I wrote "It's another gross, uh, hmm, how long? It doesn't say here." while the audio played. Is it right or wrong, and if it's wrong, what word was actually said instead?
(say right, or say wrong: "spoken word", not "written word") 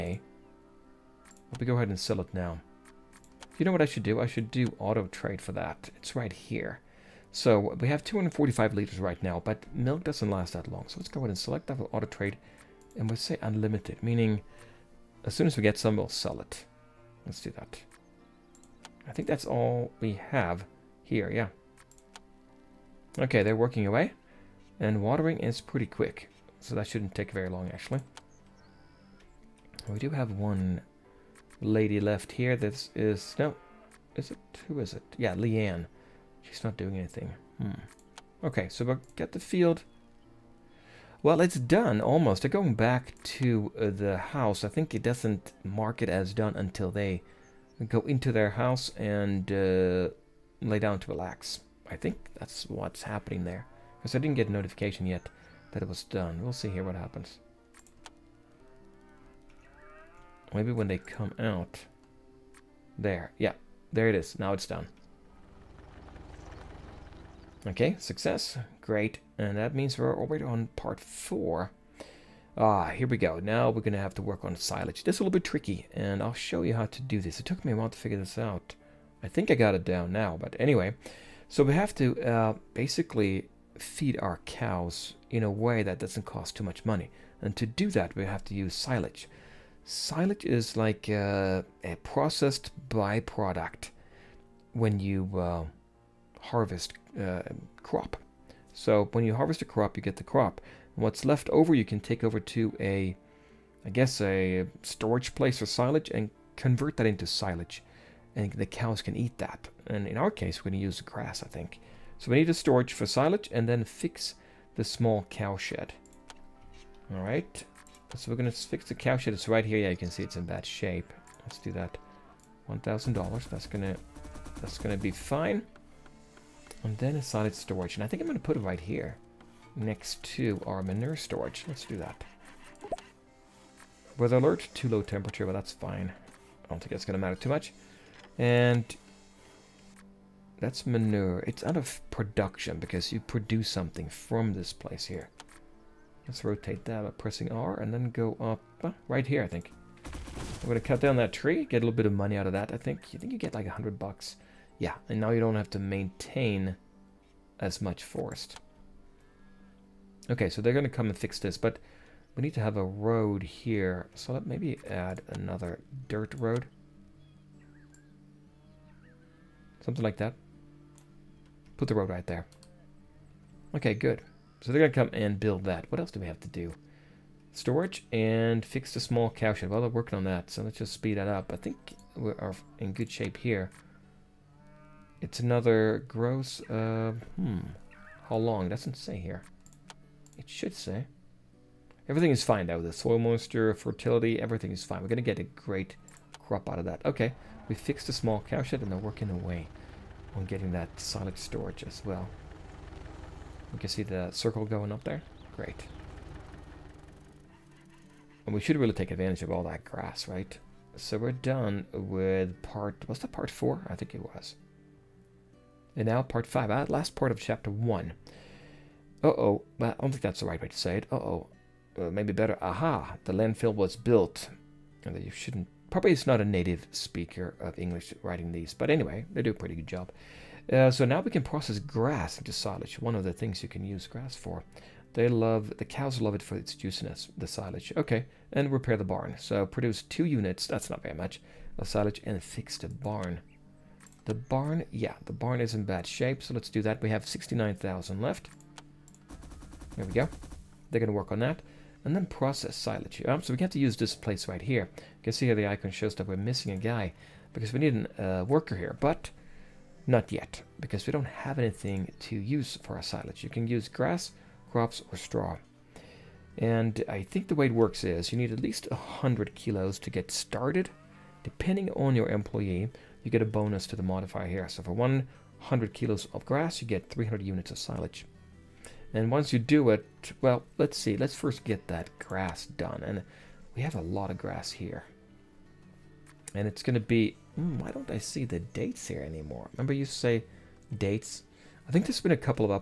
right.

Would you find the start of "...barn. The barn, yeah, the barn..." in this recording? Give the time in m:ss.
4:02.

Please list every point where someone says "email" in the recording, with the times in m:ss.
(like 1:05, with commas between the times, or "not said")
not said.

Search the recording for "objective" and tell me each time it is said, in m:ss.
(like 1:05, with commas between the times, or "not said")
not said.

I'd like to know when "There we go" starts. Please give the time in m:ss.
4:09.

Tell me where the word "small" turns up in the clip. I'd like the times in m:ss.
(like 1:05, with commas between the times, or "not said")
1:54, 2:58, 3:18.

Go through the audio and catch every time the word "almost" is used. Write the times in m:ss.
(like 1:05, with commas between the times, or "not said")
0:41.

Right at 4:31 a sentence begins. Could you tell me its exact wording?
Depending on your employee, you get a bonus to the modifier here.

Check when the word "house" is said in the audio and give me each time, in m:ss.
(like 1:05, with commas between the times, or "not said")
0:44, 0:48.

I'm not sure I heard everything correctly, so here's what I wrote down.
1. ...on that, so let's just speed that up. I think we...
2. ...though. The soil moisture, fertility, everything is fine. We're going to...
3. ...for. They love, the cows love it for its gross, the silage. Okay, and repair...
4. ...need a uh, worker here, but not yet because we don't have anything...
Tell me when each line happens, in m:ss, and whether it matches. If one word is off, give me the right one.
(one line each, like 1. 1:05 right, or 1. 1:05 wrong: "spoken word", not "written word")
1. 3:00 right
2. 3:12 right
3. 3:54 wrong: "juiciness", not "gross"
4. 4:17 right.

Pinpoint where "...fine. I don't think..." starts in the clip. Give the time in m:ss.
2:15.